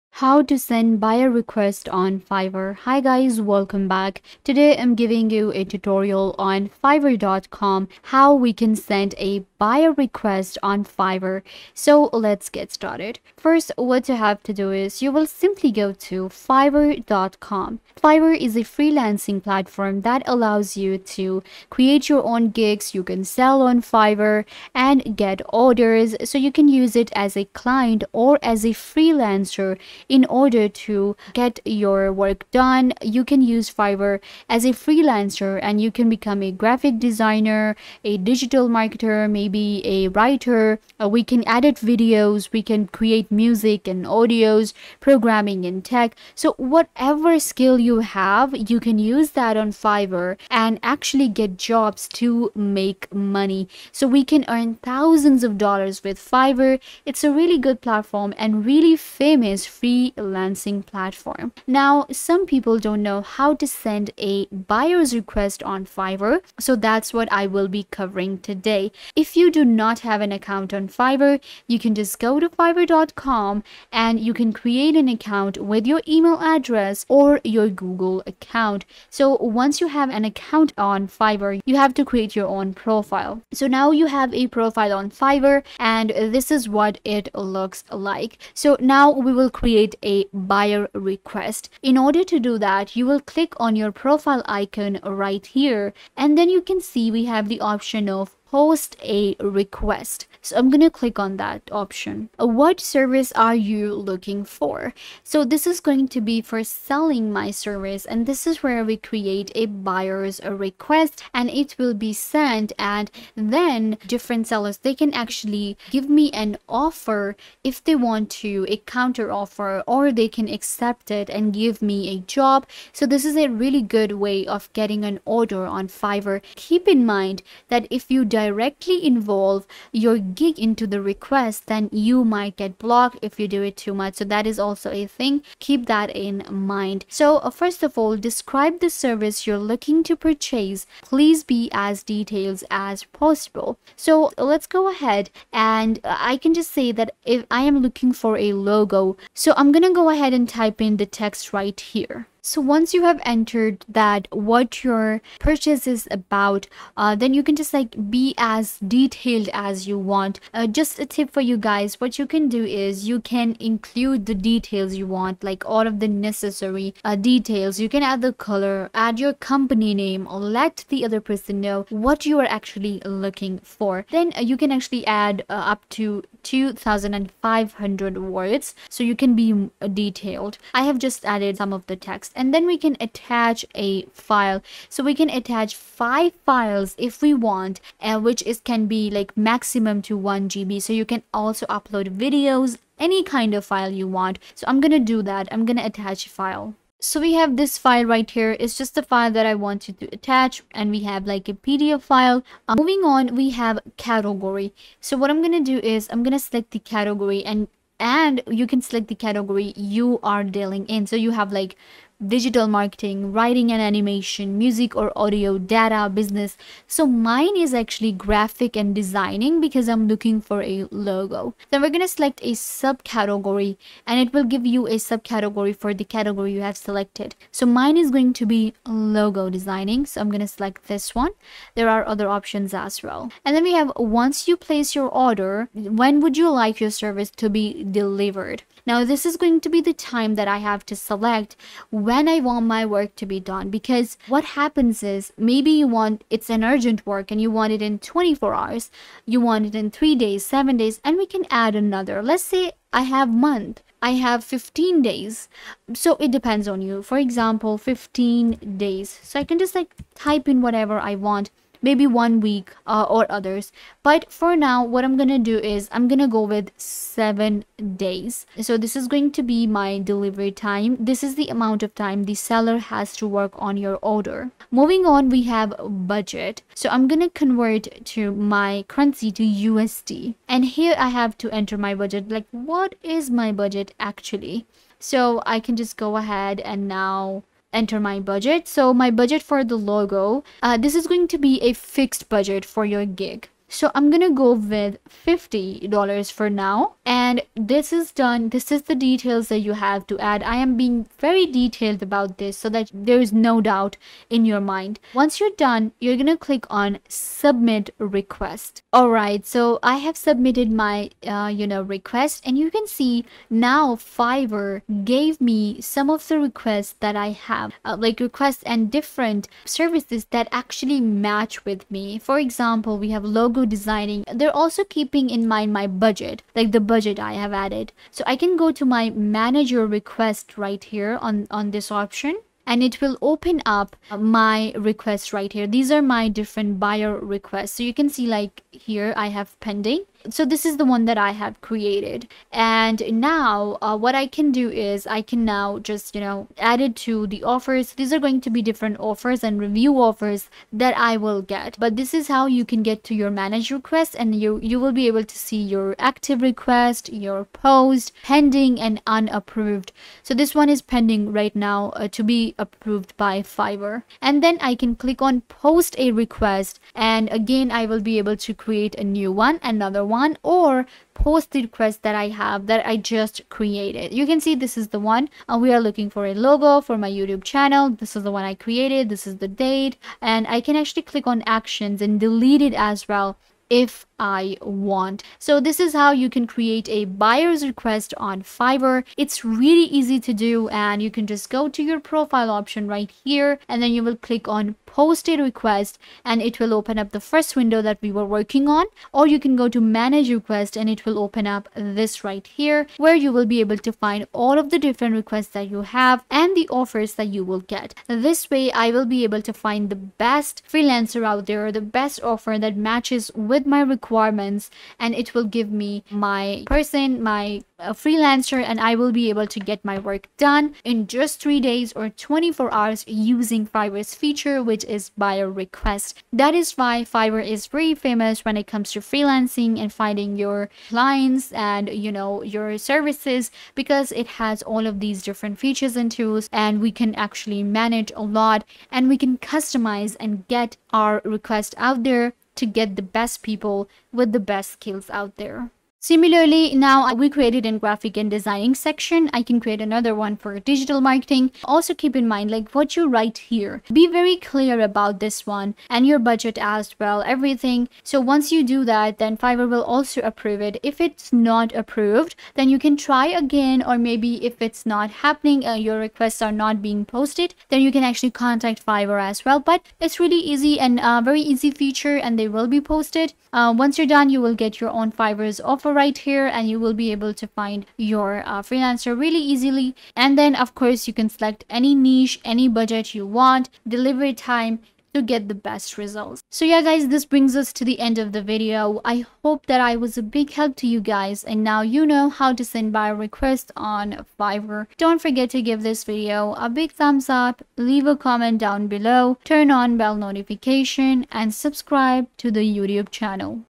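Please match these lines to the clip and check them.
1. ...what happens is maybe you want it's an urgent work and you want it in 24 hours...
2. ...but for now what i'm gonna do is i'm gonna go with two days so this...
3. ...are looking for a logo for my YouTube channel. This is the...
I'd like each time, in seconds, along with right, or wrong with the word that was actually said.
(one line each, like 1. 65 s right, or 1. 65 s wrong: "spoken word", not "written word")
1. 244 s right
2. 264 s wrong: "seven", not "two"
3. 375 s right.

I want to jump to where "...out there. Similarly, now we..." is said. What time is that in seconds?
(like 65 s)
445 s.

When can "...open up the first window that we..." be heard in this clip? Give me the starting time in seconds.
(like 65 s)
396 s.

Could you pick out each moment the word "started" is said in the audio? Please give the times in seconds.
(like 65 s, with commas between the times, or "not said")
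12 s.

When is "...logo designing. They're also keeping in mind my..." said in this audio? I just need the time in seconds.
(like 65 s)
323 s.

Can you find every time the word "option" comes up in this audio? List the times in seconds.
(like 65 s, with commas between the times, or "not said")
97 s, 101 s, 232 s, 331 s, 392 s.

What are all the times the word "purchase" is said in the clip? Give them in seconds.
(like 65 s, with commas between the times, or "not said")
140 s, 155 s.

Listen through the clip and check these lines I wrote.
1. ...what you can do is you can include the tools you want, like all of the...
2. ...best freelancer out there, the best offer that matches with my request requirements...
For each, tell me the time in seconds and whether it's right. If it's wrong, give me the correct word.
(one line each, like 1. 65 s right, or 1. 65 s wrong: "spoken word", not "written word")
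1. 162 s wrong: "details", not "tools"
2. 409 s right.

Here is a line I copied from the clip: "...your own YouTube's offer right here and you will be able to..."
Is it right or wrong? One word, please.
wrong.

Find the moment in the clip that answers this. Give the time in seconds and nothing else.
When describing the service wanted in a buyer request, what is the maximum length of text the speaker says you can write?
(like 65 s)
176 s.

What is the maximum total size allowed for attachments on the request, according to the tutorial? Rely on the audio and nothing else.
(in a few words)
1 GB.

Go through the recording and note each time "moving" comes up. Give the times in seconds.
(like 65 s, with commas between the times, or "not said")
202 s, 274 s.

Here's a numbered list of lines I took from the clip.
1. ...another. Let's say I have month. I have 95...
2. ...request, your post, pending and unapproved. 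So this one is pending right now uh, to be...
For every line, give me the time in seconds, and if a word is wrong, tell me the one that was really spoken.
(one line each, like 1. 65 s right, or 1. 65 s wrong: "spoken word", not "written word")
1. 251 s wrong: "15", not "95"
2. 356 s right.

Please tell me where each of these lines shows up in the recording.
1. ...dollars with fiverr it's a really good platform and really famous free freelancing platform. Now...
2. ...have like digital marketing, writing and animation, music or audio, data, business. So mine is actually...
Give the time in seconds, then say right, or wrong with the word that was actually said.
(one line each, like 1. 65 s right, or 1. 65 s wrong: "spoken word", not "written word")
1. 55 s right
2. 211 s right.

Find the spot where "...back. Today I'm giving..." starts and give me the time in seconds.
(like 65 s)
3 s.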